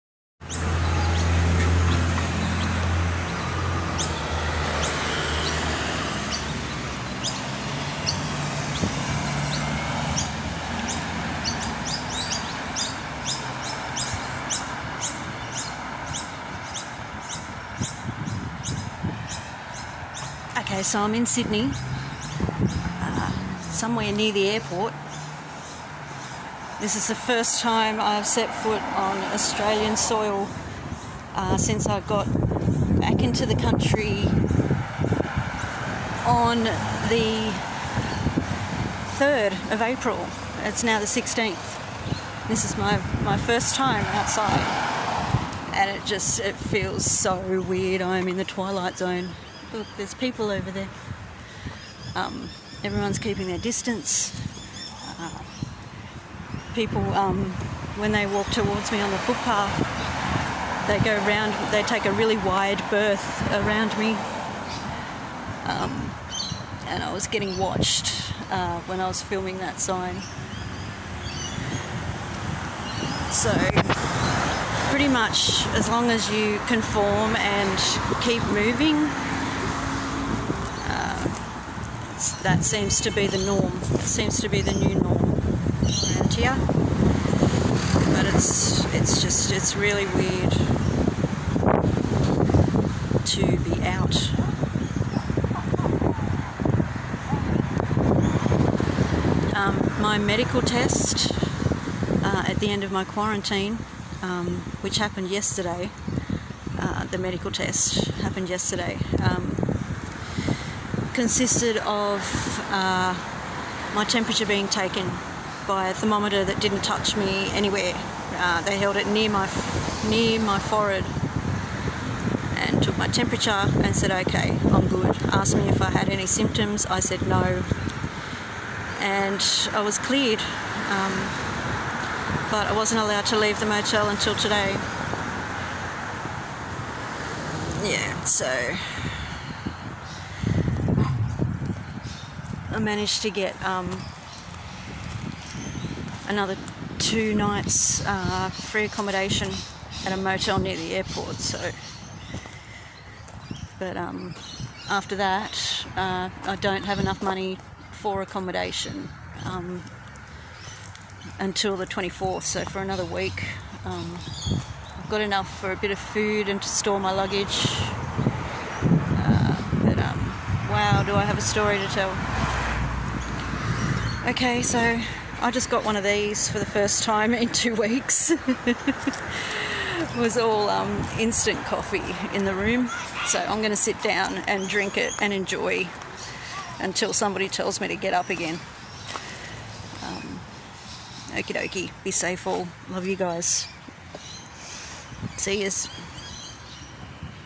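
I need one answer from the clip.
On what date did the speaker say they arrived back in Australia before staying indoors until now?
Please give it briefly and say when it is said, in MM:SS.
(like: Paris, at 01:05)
3 April, at 00:39.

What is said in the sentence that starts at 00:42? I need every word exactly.
This is my, my first time outside and it just it feels so weird.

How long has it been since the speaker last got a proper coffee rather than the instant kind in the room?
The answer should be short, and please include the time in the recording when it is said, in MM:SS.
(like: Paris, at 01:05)
2 weeks, at 02:57.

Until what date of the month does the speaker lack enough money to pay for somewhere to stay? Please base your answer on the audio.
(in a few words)
24th.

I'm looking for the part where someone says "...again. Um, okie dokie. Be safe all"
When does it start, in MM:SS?
03:08.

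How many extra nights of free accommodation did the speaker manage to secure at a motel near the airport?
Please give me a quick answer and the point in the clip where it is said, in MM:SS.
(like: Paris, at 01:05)
2, at 02:26.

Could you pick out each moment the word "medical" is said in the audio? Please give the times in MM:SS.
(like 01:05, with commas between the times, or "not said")
01:40, 01:47.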